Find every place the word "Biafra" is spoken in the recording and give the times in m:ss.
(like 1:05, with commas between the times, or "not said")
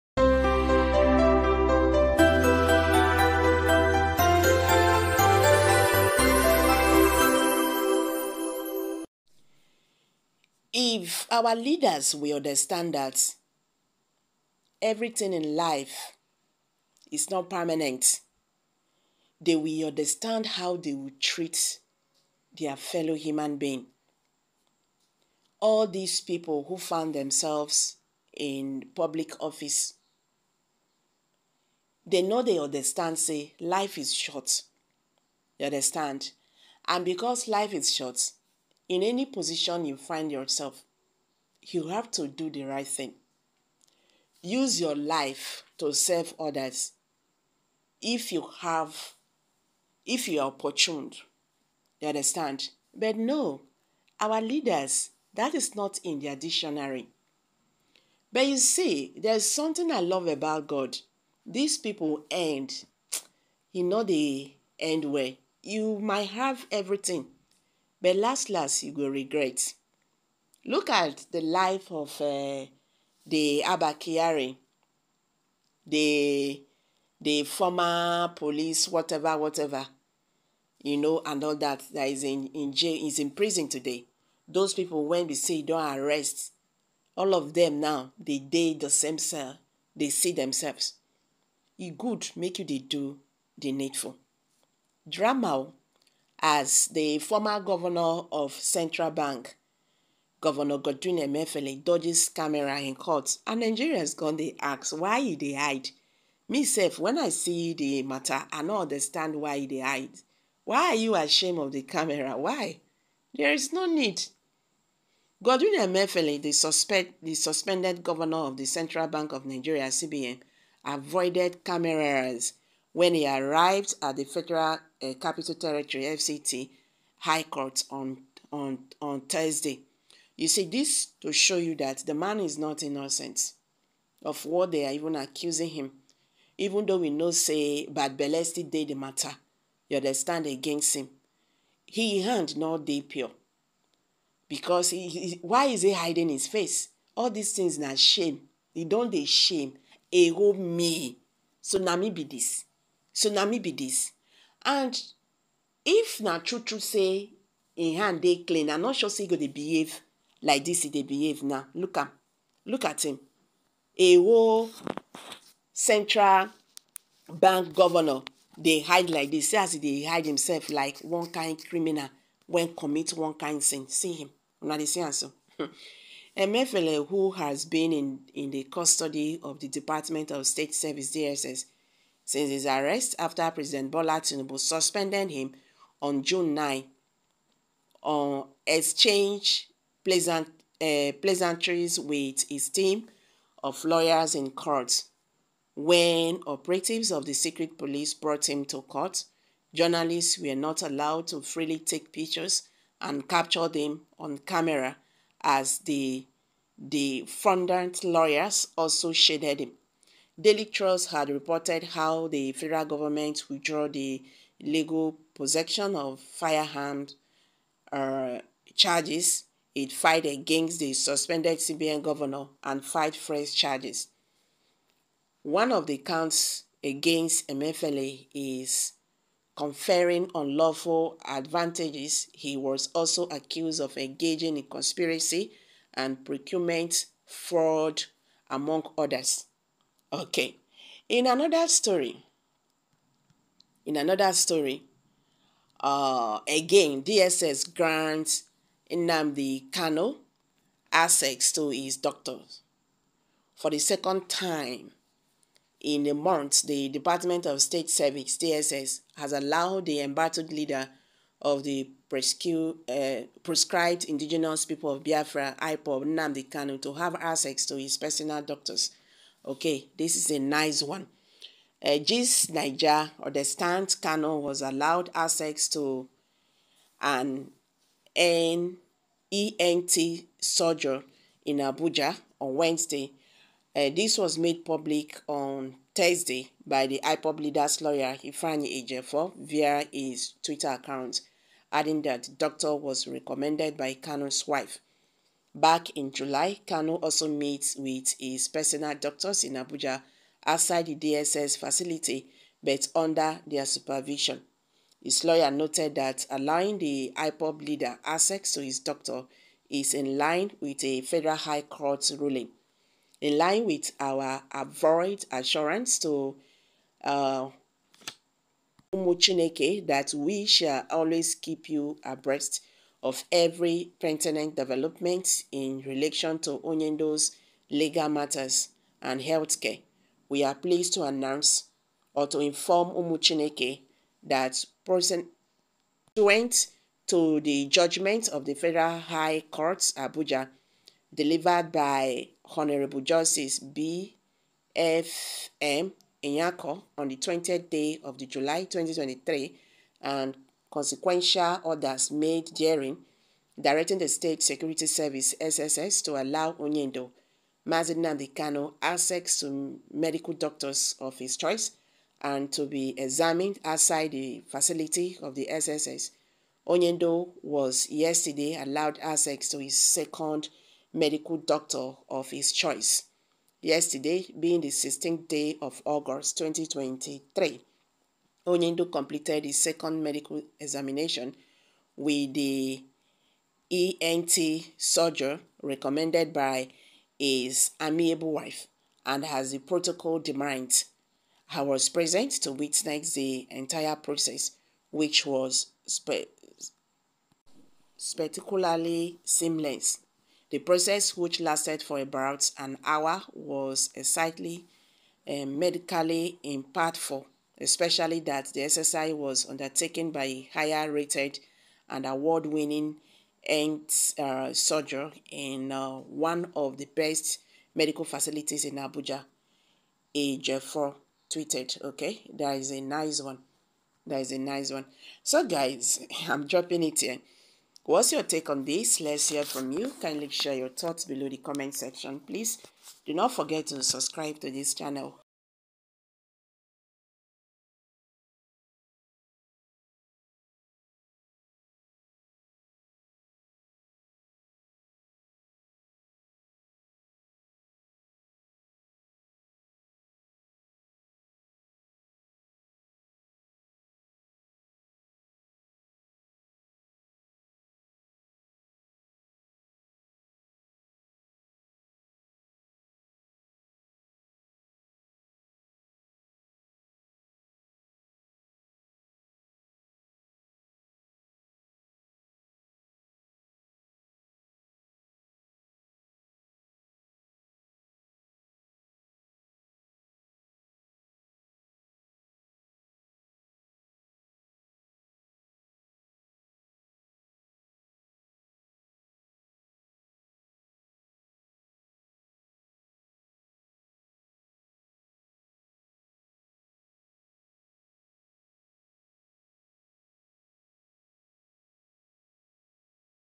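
4:25.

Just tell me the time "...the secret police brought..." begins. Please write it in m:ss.
3:17.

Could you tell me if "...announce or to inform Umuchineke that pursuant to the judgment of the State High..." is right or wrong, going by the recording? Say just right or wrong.
wrong.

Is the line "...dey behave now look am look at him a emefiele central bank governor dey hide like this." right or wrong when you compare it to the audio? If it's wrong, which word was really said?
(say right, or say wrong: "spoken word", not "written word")
wrong: "whole", not "emefiele".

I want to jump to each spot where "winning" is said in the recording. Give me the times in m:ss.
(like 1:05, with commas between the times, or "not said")
6:52.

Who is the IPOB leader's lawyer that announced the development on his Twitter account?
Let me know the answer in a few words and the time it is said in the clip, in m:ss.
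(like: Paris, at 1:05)
Ifeanyi Ejefo, at 4:48.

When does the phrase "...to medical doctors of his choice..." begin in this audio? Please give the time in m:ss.
5:59.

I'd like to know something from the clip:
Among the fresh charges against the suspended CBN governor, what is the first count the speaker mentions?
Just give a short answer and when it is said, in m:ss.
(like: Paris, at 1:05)
Conferring unlawful advantages, at 3:49.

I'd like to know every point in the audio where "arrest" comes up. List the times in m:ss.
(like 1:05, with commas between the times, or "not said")
1:25, 3:02.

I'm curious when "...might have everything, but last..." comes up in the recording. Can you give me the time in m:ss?
1:05.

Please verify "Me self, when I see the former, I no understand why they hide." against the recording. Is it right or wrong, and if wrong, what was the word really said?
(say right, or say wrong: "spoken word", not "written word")
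wrong: "matter", not "former".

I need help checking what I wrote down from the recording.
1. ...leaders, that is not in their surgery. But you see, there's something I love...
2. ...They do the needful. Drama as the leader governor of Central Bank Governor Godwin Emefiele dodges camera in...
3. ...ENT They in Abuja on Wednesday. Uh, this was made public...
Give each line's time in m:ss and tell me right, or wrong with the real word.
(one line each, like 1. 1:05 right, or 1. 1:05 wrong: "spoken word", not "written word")
1. 0:54 wrong: "dictionary", not "surgery"
2. 1:32 wrong: "former", not "leader"
3. 4:39 wrong: "Surgery", not "They".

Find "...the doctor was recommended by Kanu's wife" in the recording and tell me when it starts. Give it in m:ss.
4:52.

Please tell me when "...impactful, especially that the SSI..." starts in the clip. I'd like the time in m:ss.
6:46.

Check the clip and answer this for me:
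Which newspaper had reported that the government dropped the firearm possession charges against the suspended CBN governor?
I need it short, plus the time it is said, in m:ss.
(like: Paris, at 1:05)
Daily Trust, at 3:30.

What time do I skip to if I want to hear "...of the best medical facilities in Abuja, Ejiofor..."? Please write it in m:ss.
6:56.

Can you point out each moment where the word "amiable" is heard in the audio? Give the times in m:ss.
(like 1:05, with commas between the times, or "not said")
6:27.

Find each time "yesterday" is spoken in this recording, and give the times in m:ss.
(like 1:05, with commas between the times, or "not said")
6:07, 6:13.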